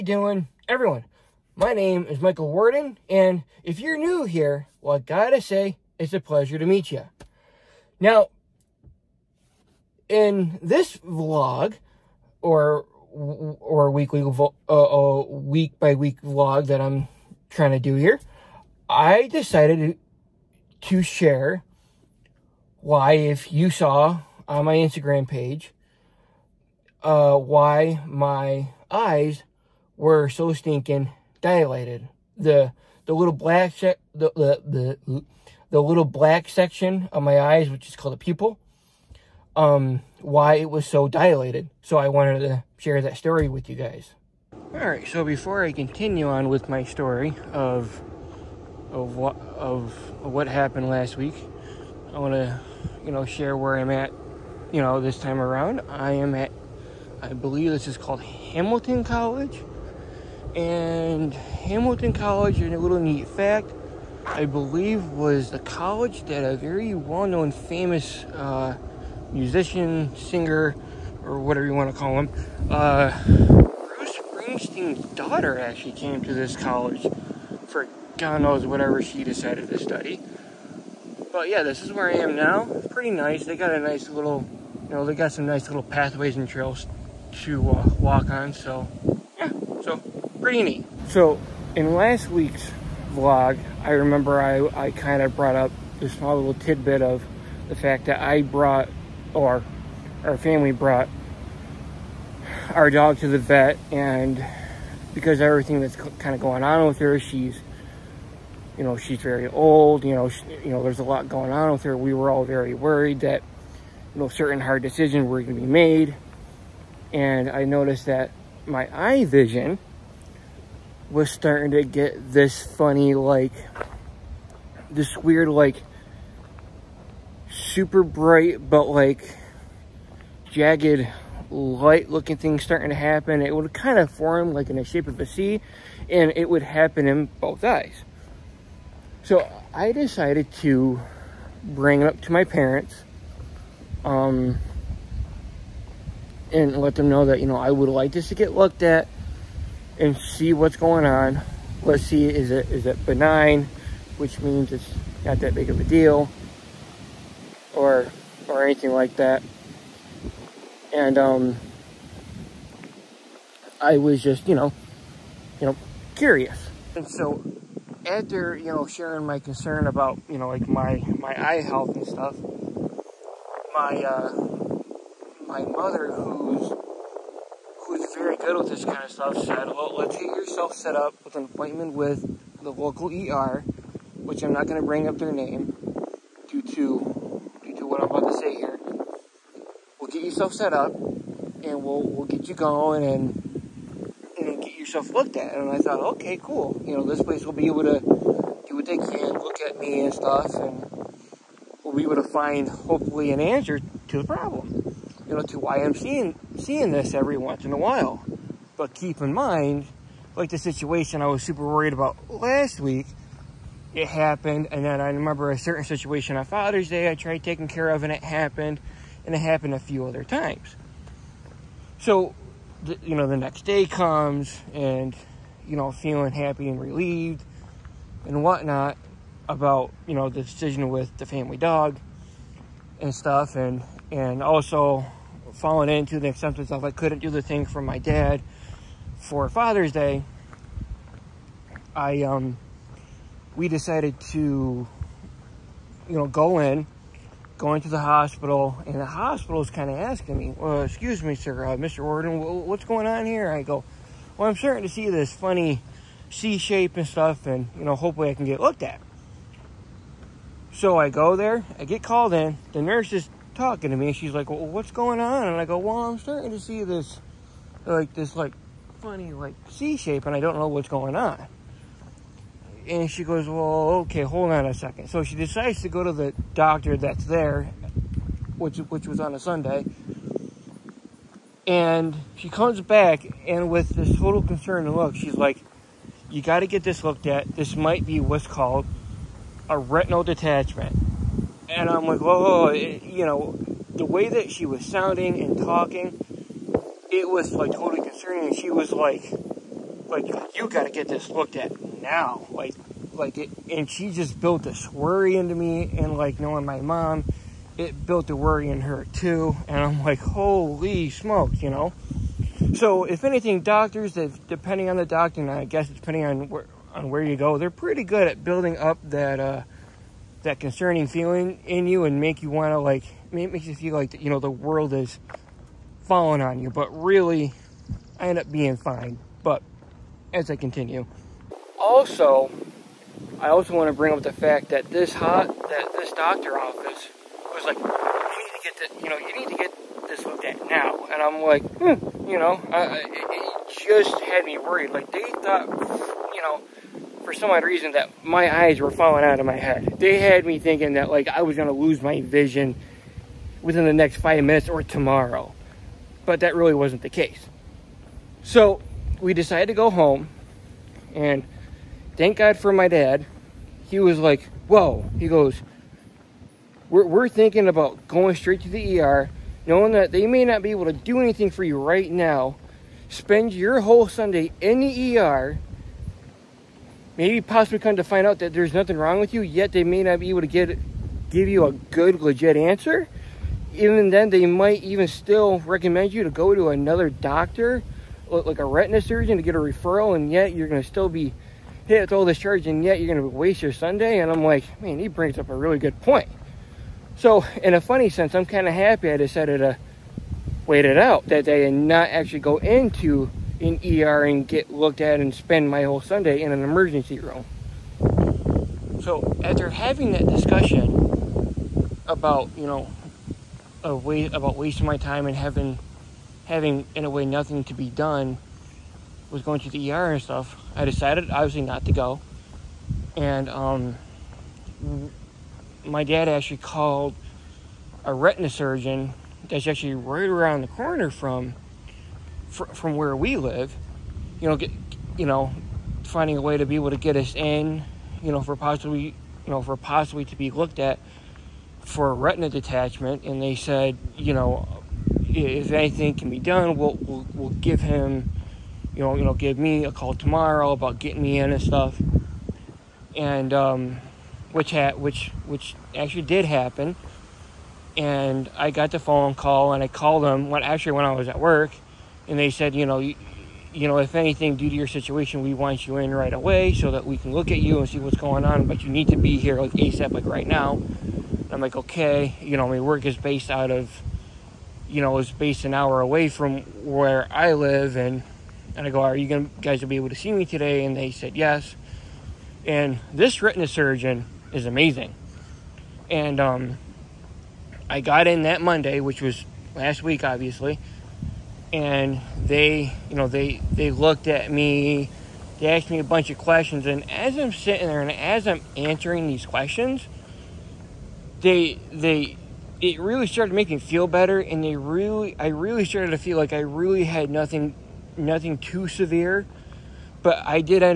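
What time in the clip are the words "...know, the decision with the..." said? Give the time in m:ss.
3:50.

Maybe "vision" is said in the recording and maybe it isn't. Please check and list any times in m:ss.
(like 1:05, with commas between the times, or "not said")
1:59, 5:52.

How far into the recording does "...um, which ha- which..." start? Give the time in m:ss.
7:33.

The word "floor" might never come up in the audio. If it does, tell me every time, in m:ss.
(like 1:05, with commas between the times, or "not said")
not said.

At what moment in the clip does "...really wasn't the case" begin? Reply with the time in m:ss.
5:56.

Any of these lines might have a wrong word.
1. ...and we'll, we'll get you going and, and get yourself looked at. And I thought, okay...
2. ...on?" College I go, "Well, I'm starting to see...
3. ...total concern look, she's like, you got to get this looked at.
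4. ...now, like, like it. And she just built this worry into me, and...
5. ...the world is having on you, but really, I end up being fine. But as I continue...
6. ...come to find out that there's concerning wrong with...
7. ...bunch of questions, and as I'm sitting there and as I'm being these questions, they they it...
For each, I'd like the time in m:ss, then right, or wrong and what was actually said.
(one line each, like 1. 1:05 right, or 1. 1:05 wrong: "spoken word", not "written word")
1. 3:10 right
2. 4:25 wrong: "And", not "College"
3. 4:44 right
4. 5:02 right
5. 5:24 wrong: "falling", not "having"
6. 6:17 wrong: "nothing", not "concerning"
7. 8:16 wrong: "answering", not "being".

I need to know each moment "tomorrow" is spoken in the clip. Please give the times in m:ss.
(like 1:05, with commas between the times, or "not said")
5:54, 7:30.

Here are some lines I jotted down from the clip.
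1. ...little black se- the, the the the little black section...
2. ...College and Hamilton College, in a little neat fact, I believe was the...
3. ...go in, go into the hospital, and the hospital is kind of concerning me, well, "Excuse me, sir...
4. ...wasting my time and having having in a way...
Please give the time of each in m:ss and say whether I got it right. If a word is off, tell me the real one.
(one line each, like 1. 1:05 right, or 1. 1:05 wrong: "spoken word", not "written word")
1. 0:33 right
2. 0:59 right
3. 4:06 wrong: "asking", not "concerning"
4. 6:54 right.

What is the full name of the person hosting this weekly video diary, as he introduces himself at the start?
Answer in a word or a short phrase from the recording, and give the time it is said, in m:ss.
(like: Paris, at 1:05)
Michael Worden, at 0:02.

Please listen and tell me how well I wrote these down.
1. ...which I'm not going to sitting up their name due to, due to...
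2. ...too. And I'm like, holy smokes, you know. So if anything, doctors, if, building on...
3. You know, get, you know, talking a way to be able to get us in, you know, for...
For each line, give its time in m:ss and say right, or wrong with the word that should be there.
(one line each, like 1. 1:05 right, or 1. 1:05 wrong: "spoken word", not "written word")
1. 3:04 wrong: "bring", not "sitting"
2. 5:09 wrong: "depending", not "building"
3. 7:14 wrong: "finding", not "talking".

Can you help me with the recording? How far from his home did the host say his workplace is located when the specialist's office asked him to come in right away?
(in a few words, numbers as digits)
An hour away.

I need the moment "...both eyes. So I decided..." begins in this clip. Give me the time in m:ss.
2:17.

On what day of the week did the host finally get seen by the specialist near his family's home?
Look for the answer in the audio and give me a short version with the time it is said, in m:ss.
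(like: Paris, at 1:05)
Monday, at 8:08.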